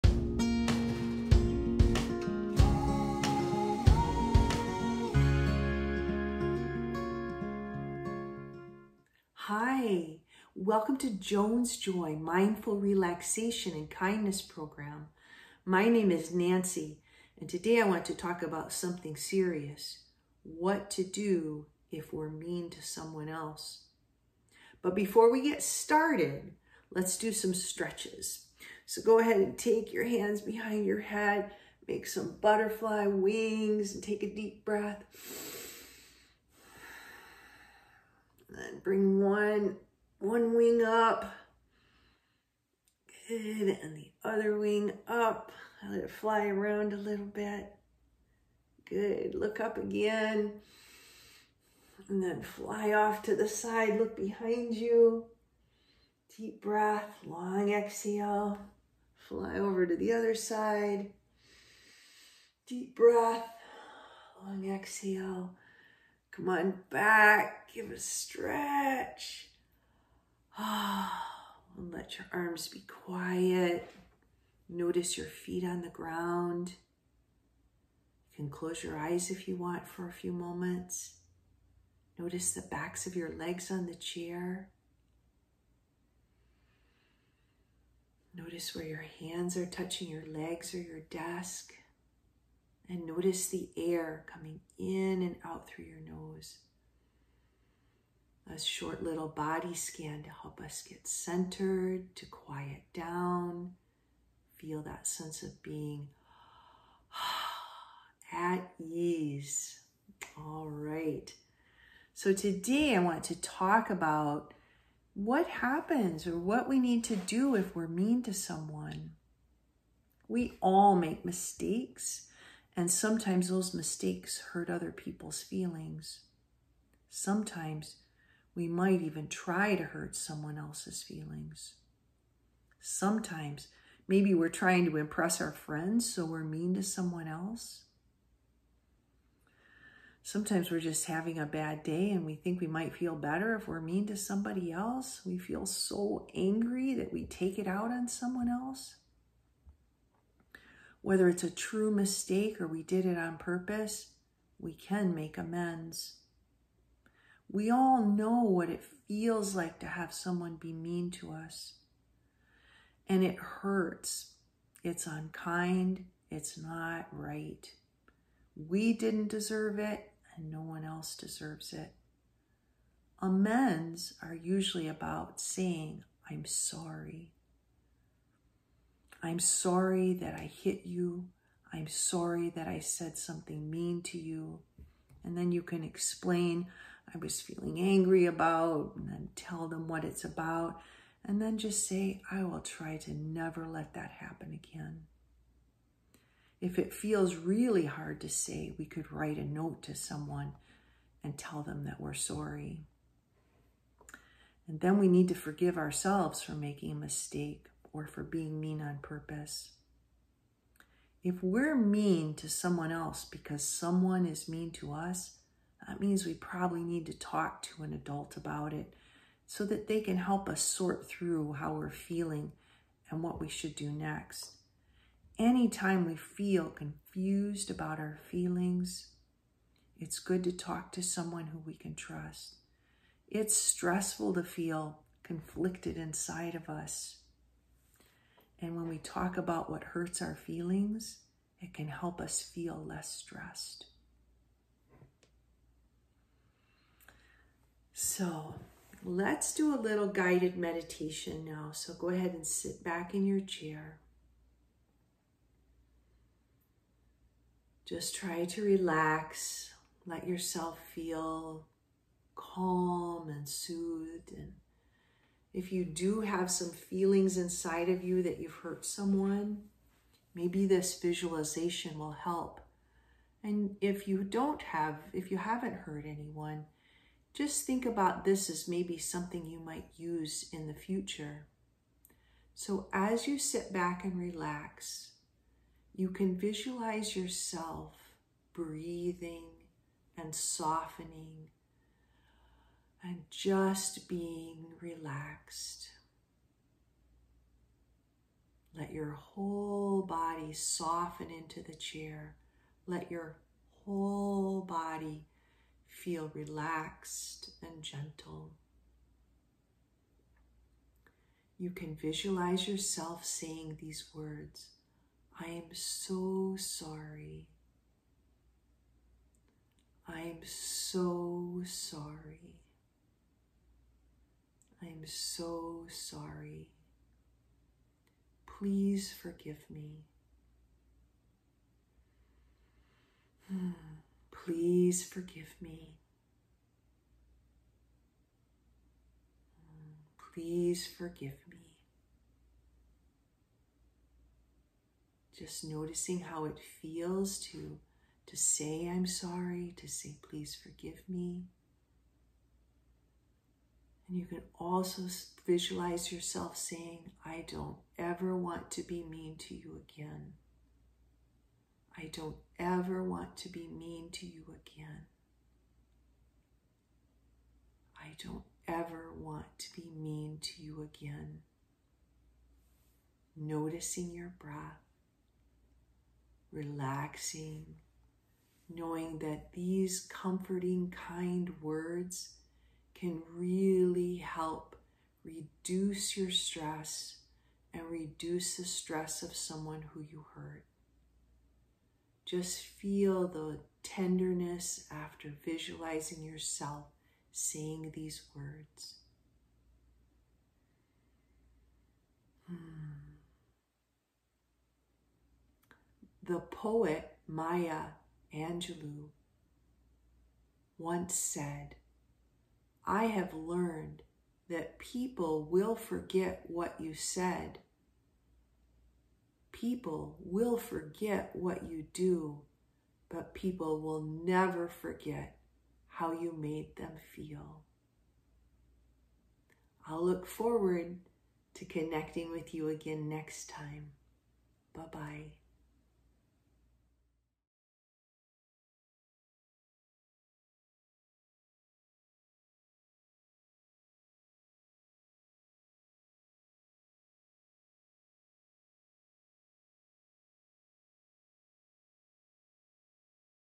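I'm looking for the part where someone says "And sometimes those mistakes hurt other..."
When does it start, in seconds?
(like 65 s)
122 s.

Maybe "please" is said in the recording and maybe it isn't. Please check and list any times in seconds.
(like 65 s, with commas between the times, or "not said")
328 s, 334 s, 340 s, 350 s.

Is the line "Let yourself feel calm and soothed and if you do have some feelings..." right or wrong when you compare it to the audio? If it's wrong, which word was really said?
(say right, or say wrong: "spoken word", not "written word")
right.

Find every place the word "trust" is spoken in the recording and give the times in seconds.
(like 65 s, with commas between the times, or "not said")
231 s.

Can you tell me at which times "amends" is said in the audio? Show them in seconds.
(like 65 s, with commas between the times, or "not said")
155 s, 173 s.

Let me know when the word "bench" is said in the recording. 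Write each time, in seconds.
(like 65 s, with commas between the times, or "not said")
not said.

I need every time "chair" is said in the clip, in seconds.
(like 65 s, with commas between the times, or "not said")
83 s, 253 s, 301 s.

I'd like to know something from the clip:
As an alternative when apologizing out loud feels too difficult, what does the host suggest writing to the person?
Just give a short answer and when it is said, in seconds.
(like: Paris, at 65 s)
a note, at 199 s.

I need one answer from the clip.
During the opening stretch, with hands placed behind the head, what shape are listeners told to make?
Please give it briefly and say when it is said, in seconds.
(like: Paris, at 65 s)
butterfly wings, at 32 s.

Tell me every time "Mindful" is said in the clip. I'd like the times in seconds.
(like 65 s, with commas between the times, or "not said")
12 s.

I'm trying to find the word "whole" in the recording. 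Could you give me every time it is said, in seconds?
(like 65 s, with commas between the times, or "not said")
299 s, 303 s.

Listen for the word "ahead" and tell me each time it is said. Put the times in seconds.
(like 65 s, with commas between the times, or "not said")
29 s, 252 s.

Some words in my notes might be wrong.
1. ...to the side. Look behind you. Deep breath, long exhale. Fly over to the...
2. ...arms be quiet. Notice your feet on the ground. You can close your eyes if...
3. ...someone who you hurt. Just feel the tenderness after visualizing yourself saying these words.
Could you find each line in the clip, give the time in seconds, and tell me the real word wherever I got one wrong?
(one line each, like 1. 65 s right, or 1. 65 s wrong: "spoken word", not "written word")
1. 53 s right
2. 72 s right
3. 389 s right.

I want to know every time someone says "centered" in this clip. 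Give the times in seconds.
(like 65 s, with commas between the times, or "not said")
101 s.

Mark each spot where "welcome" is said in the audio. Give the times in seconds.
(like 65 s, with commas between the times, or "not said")
10 s.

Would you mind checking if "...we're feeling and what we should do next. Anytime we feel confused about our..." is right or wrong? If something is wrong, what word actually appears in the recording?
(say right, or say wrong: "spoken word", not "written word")
right.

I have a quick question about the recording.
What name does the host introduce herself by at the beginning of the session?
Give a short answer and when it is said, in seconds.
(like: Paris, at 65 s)
Nancy, at 16 s.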